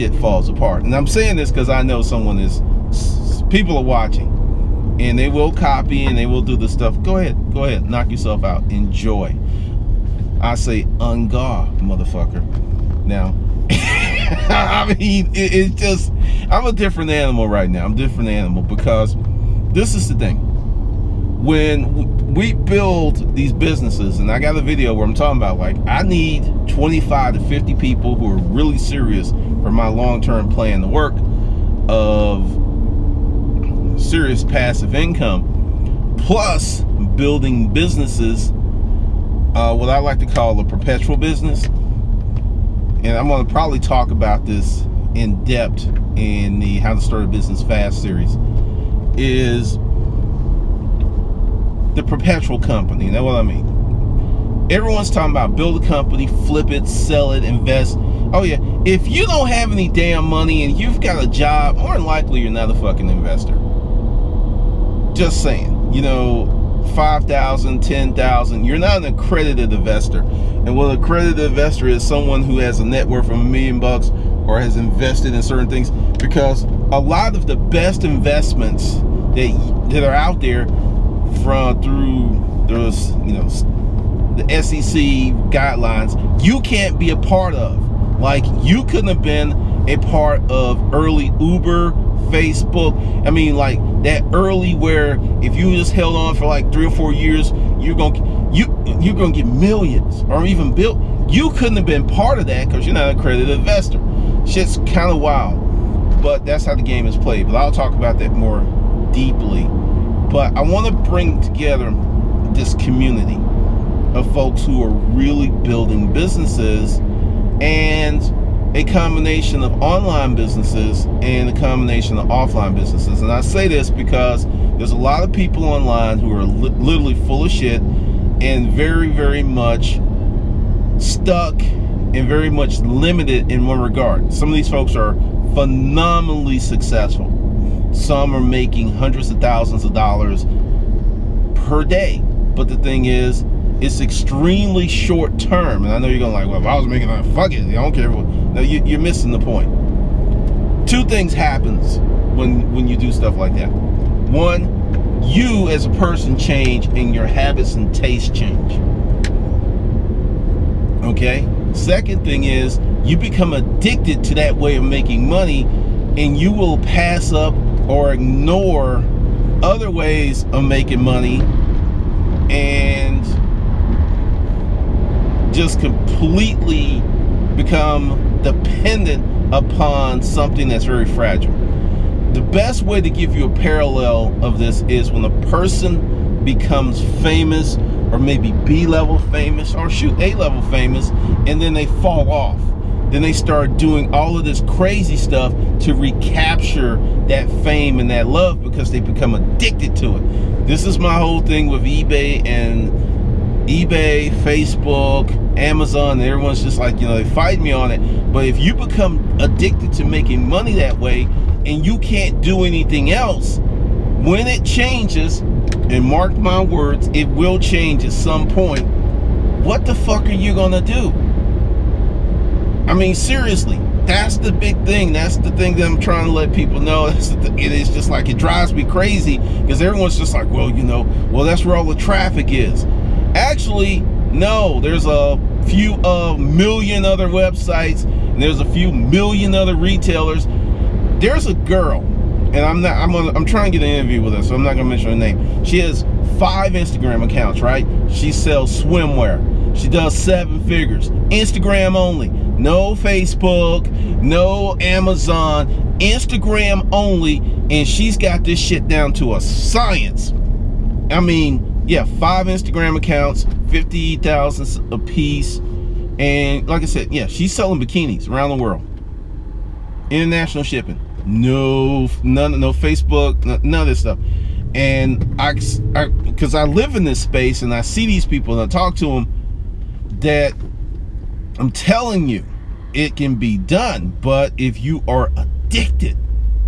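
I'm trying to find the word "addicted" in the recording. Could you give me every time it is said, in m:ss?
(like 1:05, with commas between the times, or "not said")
2:43, 3:19, 3:29, 4:45.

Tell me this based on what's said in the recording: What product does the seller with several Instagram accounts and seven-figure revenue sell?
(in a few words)
swimwear.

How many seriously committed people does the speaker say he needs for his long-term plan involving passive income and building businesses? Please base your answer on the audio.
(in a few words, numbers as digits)
25 to 50.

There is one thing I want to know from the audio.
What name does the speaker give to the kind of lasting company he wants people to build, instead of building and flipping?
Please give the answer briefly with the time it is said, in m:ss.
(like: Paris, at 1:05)
perpetual business, at 0:40.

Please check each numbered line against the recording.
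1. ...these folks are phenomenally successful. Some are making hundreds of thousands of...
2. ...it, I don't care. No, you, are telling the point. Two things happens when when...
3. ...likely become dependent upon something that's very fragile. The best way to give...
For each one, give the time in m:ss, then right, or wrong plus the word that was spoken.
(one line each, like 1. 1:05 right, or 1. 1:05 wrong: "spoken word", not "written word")
1. 2:14 right
2. 2:27 wrong: "missing", not "telling"
3. 2:55 wrong: "completely", not "likely".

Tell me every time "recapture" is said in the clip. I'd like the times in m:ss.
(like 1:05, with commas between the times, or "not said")
3:15.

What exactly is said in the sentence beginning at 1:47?
But I'll talk about that more deeply.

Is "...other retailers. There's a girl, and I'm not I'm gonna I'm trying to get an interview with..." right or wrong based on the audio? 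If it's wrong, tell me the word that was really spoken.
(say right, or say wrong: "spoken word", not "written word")
right.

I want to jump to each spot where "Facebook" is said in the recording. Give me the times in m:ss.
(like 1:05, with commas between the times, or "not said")
1:32, 3:24, 4:12, 4:32.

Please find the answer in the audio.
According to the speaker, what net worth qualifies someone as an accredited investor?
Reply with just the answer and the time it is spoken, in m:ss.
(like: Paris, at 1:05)
a million bucks, at 1:13.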